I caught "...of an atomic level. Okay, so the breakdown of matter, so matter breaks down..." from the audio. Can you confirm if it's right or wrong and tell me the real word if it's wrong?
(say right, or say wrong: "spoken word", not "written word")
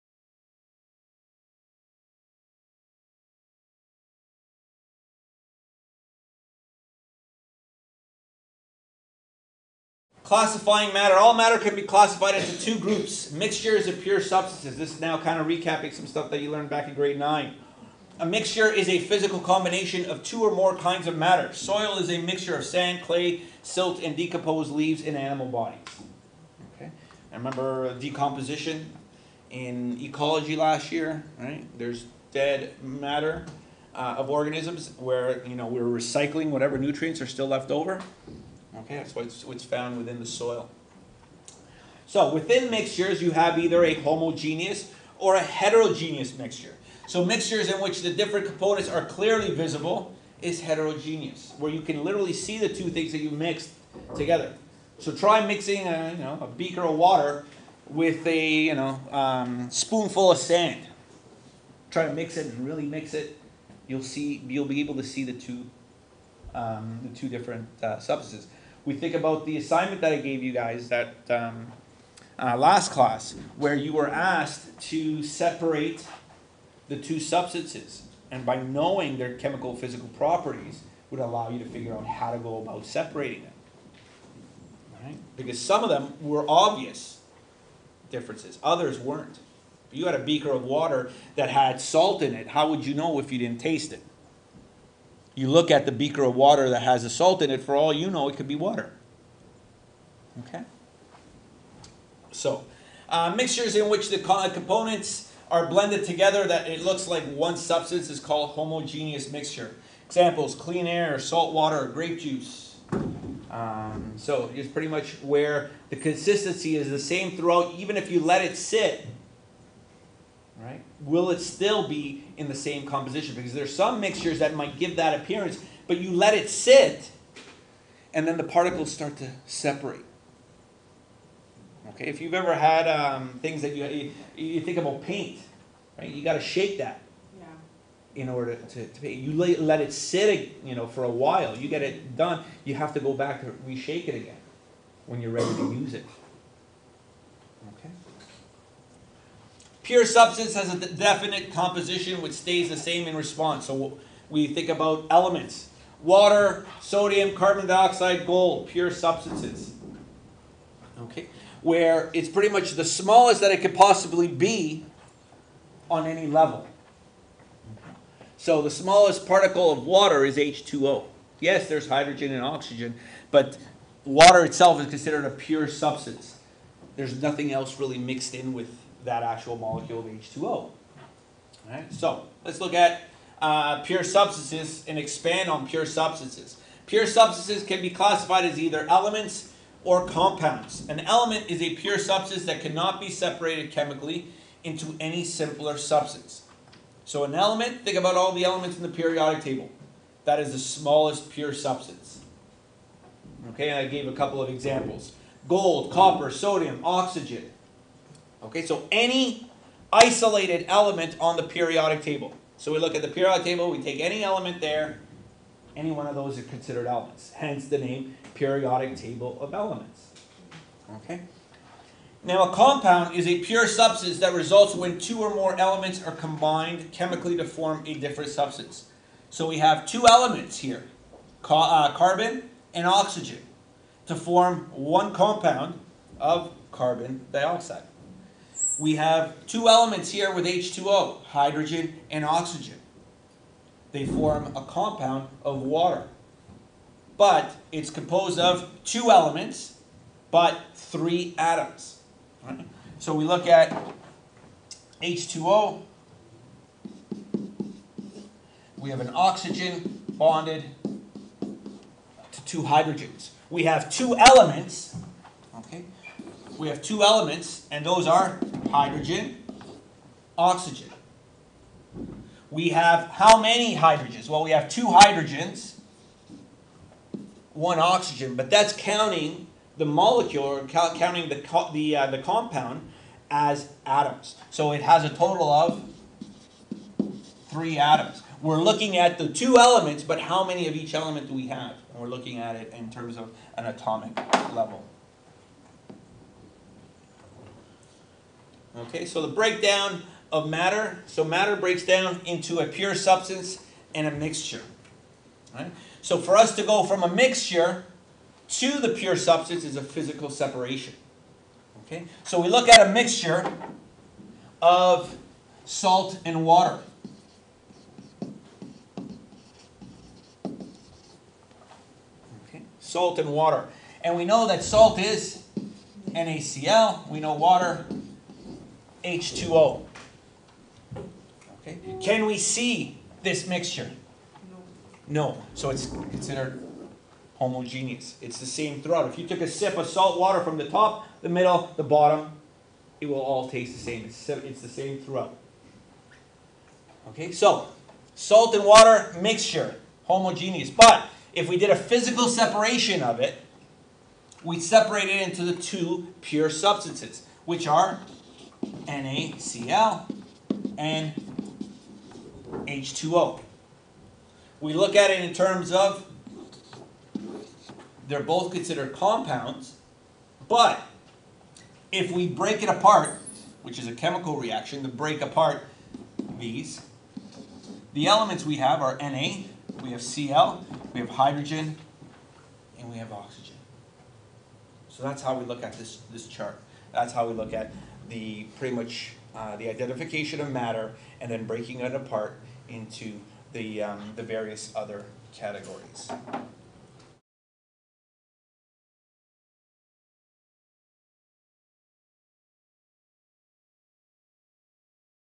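right.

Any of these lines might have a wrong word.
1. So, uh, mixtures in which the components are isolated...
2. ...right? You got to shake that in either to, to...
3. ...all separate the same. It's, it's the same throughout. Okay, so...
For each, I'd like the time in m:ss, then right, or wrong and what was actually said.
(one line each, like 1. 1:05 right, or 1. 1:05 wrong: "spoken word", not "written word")
1. 1:42 wrong: "blended", not "isolated"
2. 2:15 wrong: "order", not "either"
3. 5:43 wrong: "taste", not "separate".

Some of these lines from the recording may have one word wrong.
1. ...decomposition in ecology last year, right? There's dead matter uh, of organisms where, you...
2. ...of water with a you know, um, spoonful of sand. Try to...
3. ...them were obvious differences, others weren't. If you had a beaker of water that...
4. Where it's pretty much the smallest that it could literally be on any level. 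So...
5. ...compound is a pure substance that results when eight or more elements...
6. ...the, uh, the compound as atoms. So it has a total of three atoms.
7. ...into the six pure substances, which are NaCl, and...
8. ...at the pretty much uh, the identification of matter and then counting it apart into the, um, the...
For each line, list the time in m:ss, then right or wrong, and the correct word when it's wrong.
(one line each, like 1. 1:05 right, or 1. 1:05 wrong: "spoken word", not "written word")
1. 0:27 right
2. 0:56 right
3. 1:25 right
4. 2:41 wrong: "possibly", not "literally"
5. 3:42 wrong: "two", not "eight"
6. 4:41 right
7. 5:55 wrong: "two", not "six"
8. 6:27 wrong: "breaking", not "counting".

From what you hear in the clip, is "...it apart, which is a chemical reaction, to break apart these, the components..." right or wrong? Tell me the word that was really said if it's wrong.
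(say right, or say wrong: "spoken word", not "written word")
wrong: "elements", not "components".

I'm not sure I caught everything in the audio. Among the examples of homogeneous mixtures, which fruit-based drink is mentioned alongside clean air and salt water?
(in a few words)
grape juice.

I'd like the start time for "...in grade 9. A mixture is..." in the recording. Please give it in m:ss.
0:16.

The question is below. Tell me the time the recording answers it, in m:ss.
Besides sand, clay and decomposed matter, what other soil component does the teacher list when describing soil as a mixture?
0:23.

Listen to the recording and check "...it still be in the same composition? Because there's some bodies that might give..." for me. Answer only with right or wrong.
wrong.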